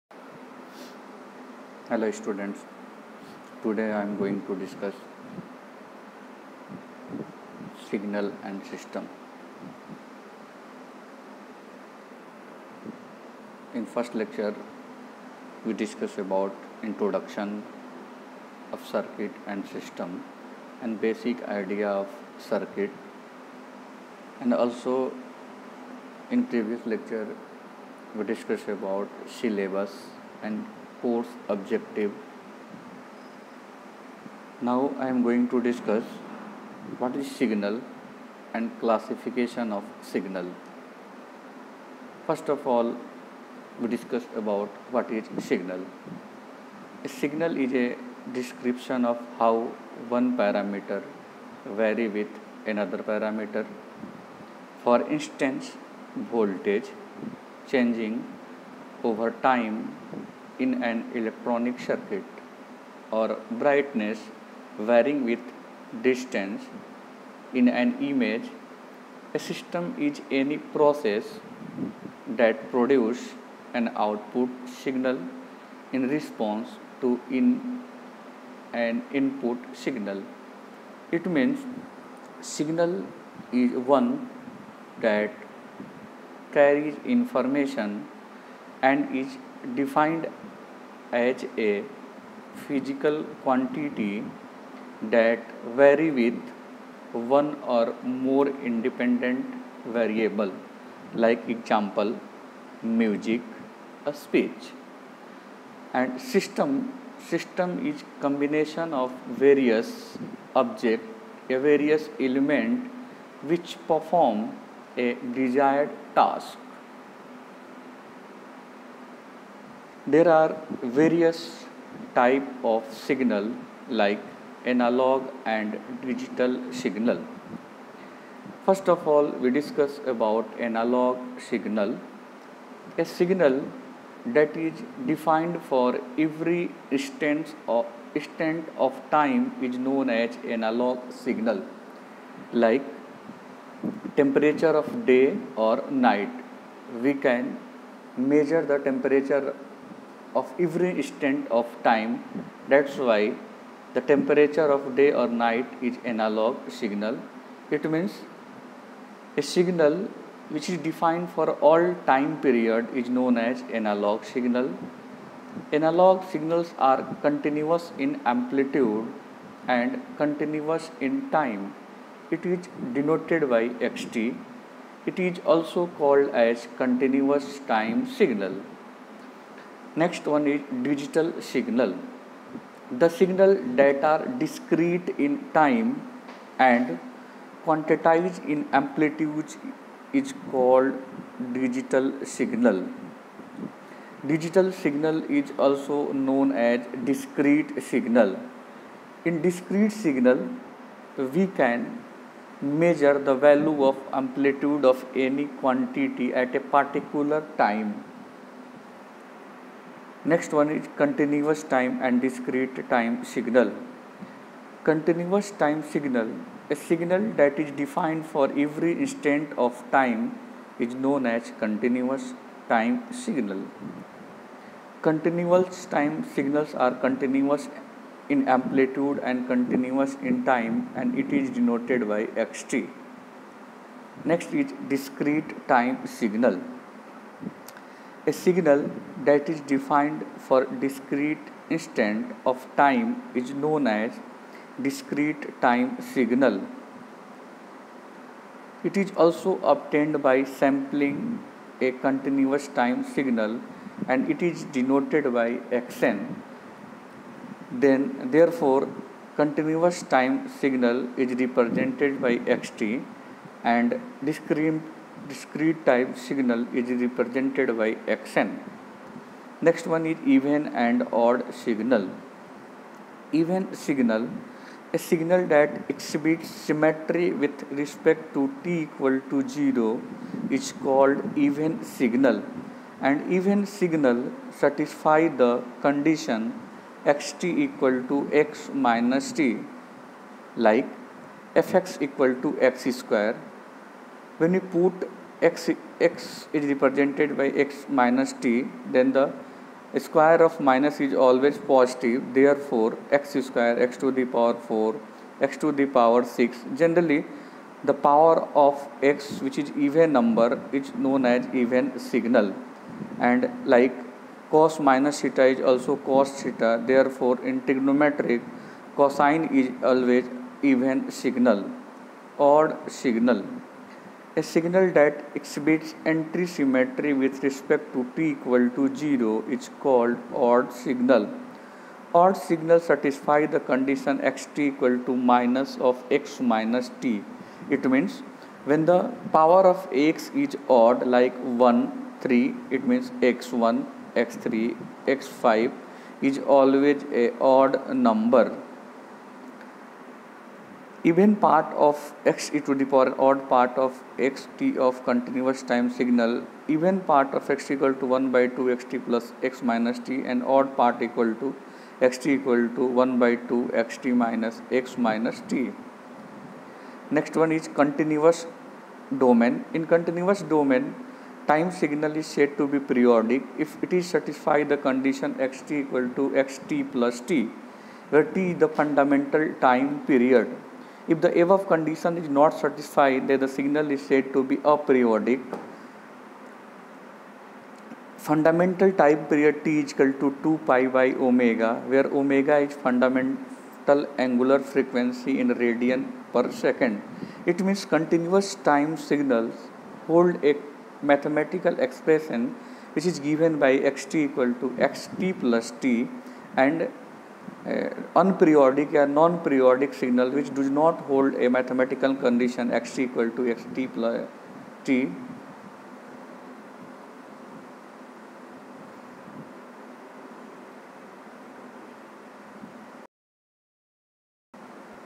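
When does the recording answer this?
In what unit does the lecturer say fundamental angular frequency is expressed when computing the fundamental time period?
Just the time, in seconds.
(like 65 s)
395 s.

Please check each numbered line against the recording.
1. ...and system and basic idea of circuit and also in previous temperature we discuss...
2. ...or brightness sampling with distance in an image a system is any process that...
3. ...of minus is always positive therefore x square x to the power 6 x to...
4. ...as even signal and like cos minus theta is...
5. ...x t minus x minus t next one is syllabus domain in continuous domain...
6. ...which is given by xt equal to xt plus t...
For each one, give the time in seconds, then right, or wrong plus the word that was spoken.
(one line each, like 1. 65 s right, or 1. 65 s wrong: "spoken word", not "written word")
1. 19 s wrong: "lecture", not "temperature"
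2. 63 s wrong: "varying", not "sampling"
3. 300 s wrong: "4", not "6"
4. 311 s right
5. 363 s wrong: "continuous", not "syllabus"
6. 402 s right.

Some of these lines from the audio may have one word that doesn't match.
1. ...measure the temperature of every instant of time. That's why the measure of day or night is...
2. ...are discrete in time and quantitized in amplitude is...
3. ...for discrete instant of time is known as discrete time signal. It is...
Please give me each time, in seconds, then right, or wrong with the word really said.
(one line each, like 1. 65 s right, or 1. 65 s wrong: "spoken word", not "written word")
1. 148 s wrong: "temperature", not "measure"
2. 184 s right
3. 240 s right.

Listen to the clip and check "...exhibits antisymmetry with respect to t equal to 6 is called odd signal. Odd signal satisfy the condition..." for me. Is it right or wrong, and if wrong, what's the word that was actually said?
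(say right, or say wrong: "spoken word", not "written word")
wrong: "0", not "6".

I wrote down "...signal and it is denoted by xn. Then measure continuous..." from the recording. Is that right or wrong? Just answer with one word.
wrong.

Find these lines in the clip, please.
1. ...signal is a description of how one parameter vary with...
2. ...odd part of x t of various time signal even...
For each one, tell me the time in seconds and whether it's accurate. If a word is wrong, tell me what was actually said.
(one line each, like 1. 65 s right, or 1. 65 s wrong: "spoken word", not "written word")
1. 47 s right
2. 353 s wrong: "continuous", not "various".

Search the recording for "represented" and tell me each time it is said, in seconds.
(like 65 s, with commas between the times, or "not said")
261 s, 267 s, 296 s.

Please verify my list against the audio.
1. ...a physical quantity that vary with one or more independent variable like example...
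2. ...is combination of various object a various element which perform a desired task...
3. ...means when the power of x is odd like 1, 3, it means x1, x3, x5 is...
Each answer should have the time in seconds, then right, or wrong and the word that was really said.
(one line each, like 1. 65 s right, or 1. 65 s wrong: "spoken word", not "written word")
1. 91 s right
2. 107 s right
3. 337 s right.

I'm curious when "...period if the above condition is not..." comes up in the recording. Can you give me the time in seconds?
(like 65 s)
380 s.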